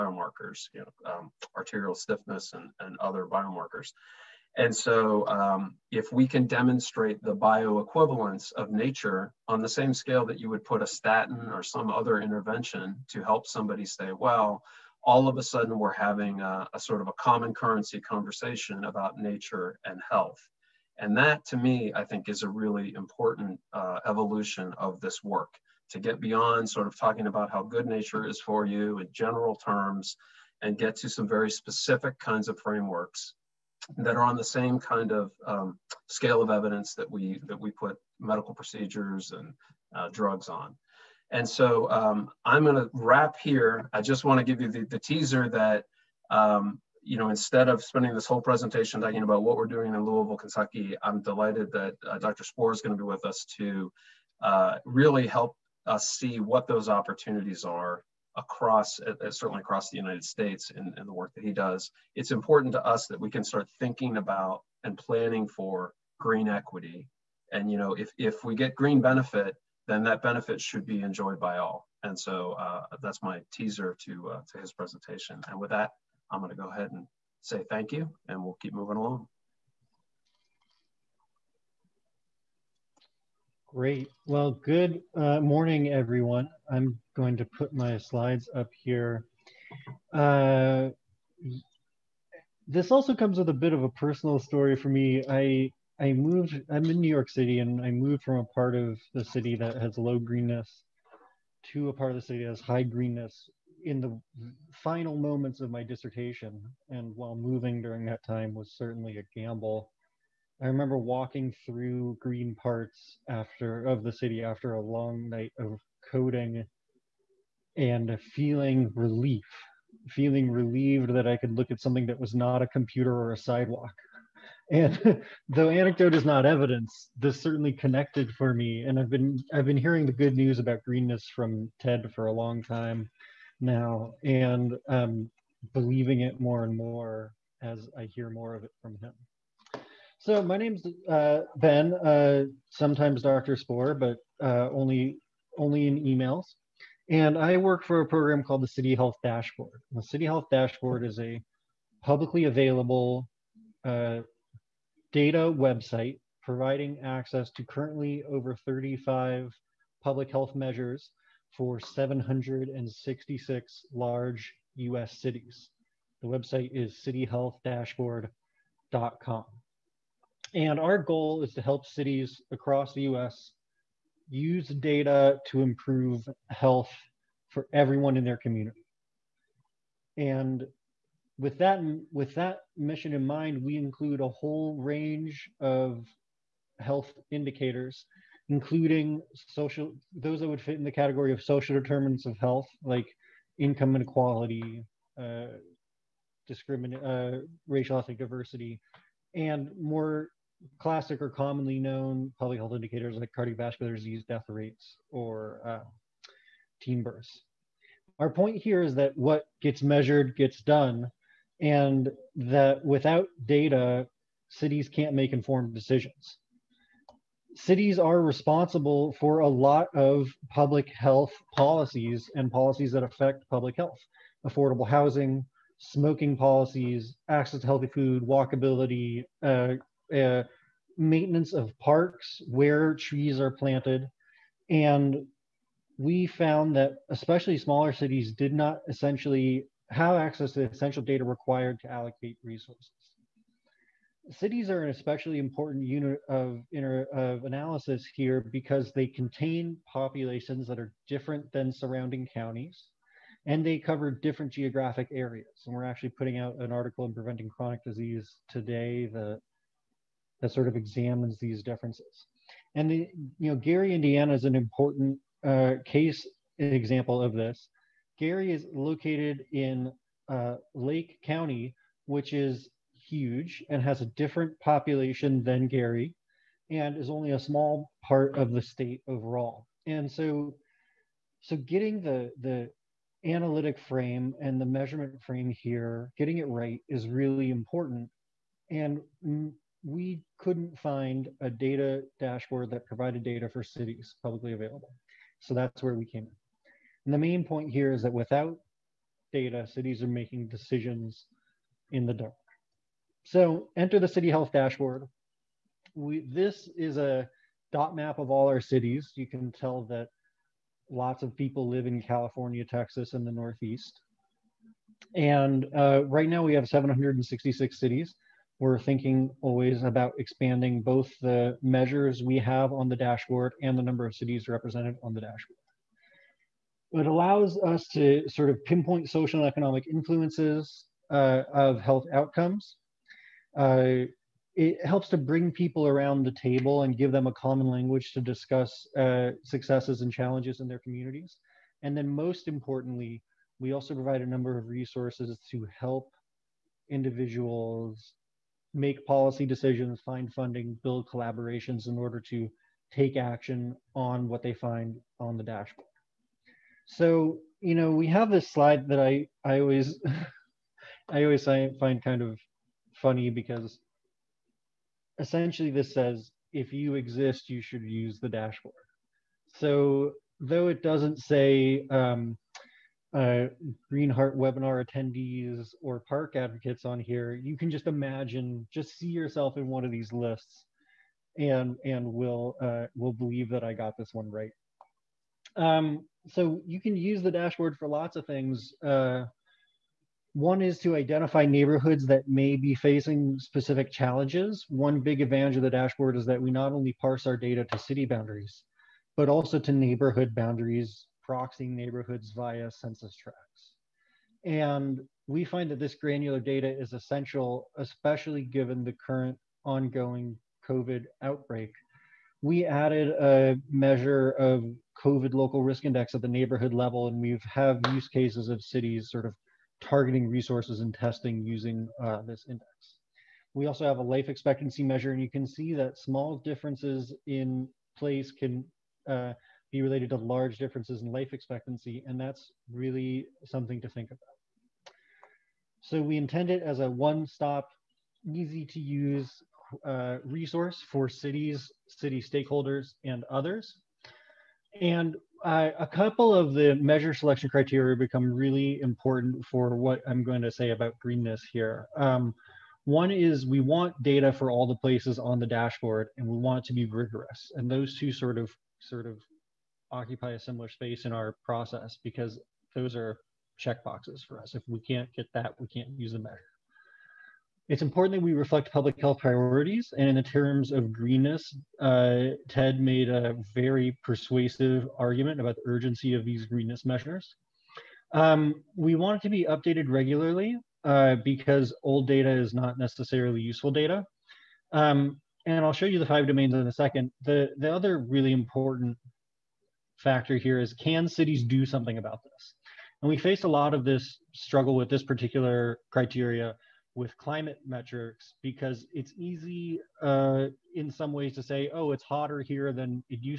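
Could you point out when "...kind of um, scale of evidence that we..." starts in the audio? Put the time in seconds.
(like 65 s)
34 s.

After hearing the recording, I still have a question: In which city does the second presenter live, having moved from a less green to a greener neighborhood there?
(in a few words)
New York City.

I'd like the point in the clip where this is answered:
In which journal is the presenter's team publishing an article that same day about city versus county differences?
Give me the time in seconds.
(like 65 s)
257 s.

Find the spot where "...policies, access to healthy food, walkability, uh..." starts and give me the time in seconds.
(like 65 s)
226 s.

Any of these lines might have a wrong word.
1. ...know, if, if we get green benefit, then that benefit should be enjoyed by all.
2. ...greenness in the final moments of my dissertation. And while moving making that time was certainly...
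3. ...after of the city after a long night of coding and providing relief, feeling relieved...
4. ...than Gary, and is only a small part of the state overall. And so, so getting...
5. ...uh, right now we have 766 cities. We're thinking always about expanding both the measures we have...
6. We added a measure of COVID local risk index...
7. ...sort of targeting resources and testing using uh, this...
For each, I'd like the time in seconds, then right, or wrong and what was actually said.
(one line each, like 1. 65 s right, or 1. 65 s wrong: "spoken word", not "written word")
1. 67 s right
2. 102 s wrong: "during", not "making"
3. 113 s wrong: "feeling", not "providing"
4. 275 s right
5. 315 s right
6. 412 s right
7. 419 s right.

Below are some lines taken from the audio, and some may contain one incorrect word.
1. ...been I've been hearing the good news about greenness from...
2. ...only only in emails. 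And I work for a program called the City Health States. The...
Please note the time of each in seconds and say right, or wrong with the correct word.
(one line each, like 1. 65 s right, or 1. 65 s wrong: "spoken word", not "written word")
1. 129 s right
2. 144 s wrong: "Dashboard", not "States".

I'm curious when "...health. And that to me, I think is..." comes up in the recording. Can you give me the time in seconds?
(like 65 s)
20 s.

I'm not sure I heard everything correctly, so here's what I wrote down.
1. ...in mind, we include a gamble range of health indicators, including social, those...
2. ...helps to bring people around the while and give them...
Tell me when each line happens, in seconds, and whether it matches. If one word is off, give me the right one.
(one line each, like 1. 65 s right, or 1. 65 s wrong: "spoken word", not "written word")
1. 183 s wrong: "whole", not "gamble"
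2. 334 s wrong: "table", not "while".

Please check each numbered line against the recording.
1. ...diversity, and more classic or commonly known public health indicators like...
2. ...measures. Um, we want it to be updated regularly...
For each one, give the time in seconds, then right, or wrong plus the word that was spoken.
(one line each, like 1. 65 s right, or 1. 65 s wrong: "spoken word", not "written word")
1. 198 s right
2. 476 s right.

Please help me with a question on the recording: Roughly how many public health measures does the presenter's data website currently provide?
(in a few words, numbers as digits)
over 35.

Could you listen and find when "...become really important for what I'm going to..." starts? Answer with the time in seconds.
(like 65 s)
447 s.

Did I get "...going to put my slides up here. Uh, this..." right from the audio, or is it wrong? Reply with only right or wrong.
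right.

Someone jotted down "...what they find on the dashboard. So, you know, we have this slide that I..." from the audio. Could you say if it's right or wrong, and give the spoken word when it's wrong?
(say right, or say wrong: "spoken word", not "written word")
right.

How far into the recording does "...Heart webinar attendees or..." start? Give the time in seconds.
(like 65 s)
374 s.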